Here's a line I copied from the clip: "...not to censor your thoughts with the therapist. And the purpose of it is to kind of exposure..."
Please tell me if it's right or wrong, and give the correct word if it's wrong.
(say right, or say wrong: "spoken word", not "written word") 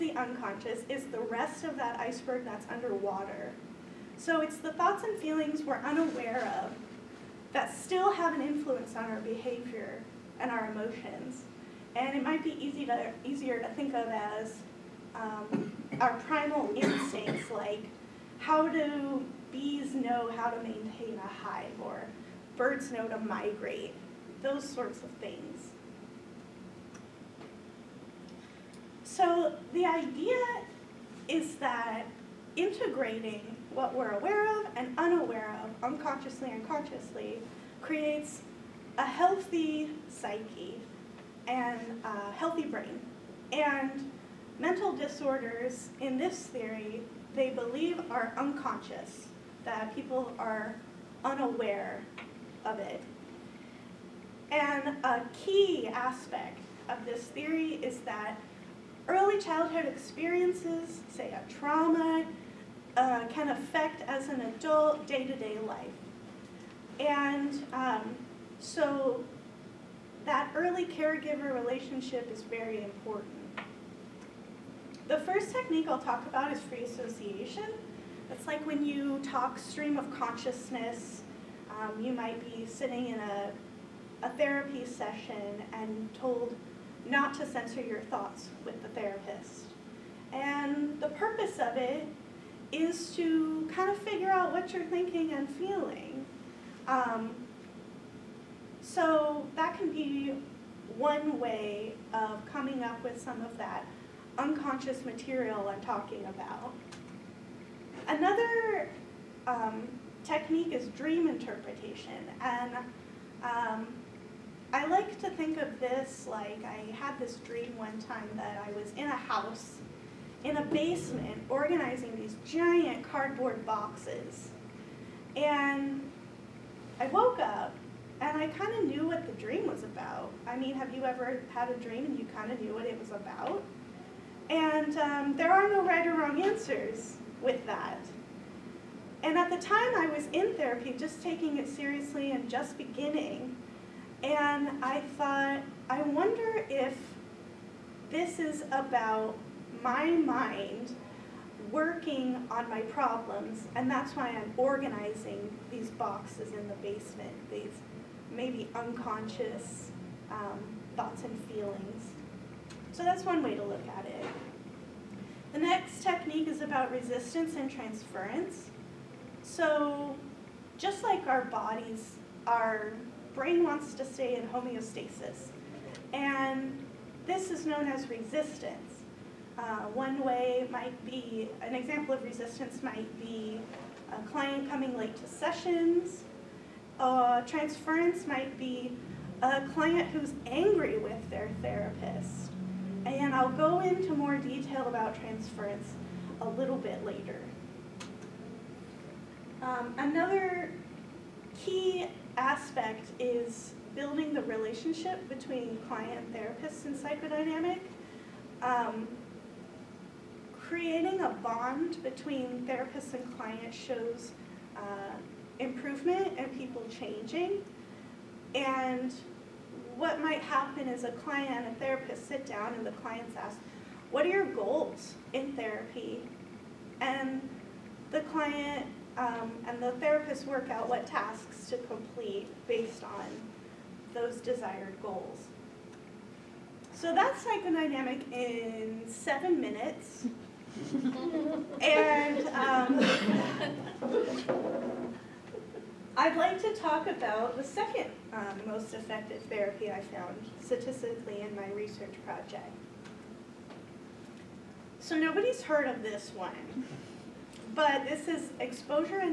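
wrong: "figure", not "exposure".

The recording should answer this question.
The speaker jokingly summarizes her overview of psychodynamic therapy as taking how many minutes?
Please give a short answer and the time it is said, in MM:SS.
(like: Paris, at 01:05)
7, at 03:59.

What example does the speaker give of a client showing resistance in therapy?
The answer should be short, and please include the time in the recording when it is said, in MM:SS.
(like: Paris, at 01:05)
coming late to sessions, at 03:04.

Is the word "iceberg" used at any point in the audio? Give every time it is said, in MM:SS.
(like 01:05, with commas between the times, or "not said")
00:01.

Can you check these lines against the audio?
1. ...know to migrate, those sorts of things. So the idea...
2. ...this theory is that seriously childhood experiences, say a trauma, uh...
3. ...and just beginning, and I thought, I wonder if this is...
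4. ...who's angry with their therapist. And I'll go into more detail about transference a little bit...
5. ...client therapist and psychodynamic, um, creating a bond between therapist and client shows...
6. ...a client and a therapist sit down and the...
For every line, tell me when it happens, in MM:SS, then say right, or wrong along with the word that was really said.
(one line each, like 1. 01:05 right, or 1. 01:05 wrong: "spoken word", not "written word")
1. 00:22 right
2. 00:57 wrong: "early", not "seriously"
3. 02:22 right
4. 03:10 right
5. 03:25 right
6. 03:41 right.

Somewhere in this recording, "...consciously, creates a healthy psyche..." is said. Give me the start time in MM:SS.
00:36.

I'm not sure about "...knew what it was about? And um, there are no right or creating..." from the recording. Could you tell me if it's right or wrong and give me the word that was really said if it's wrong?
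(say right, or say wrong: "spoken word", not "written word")
wrong: "wrong", not "creating".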